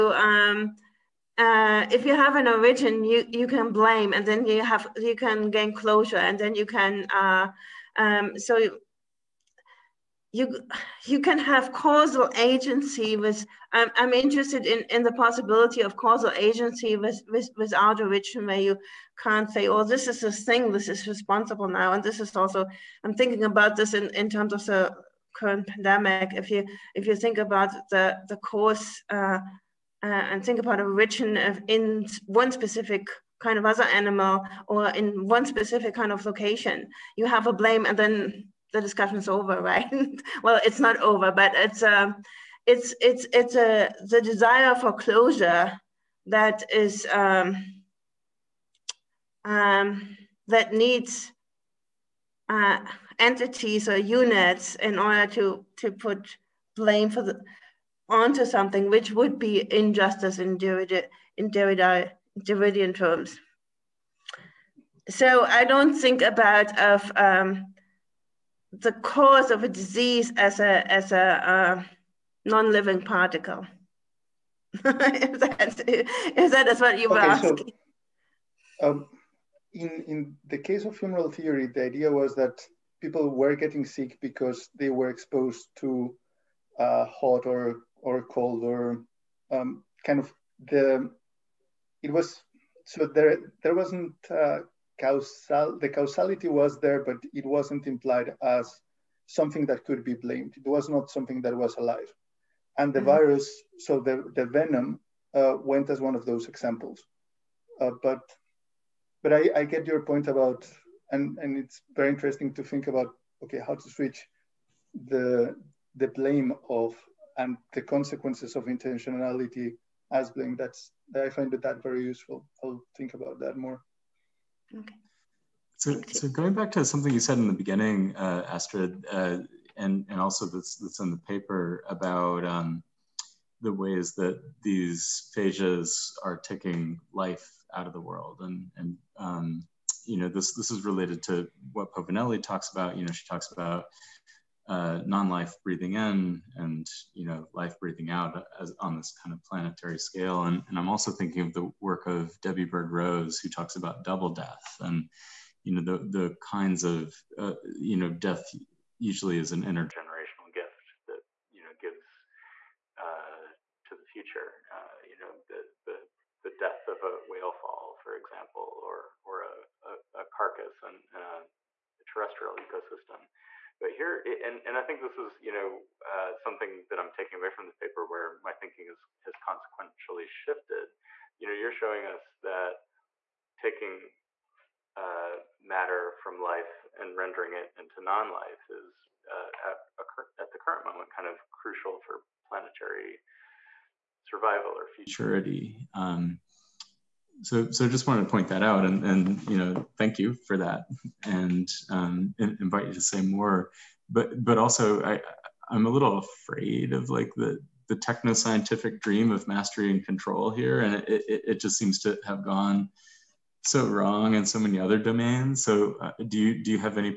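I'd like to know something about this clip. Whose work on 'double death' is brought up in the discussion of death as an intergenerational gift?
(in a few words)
Debbie Bird Rose.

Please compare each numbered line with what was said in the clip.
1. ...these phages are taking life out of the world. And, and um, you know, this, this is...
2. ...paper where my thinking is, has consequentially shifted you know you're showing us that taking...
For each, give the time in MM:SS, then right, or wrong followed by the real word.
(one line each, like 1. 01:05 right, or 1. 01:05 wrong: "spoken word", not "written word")
1. 02:14 right
2. 02:57 right.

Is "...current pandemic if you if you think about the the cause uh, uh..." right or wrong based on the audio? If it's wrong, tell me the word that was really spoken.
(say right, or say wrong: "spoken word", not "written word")
right.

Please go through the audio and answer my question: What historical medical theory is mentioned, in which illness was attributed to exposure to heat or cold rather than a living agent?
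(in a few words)
Humoral theory.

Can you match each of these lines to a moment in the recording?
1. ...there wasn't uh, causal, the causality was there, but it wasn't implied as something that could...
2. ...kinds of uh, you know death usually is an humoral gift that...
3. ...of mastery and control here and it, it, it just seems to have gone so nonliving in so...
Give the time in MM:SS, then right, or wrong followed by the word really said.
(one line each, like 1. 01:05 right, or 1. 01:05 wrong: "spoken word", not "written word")
1. 01:33 right
2. 02:36 wrong: "intergenerational", not "humoral"
3. 03:29 wrong: "wrong", not "nonliving".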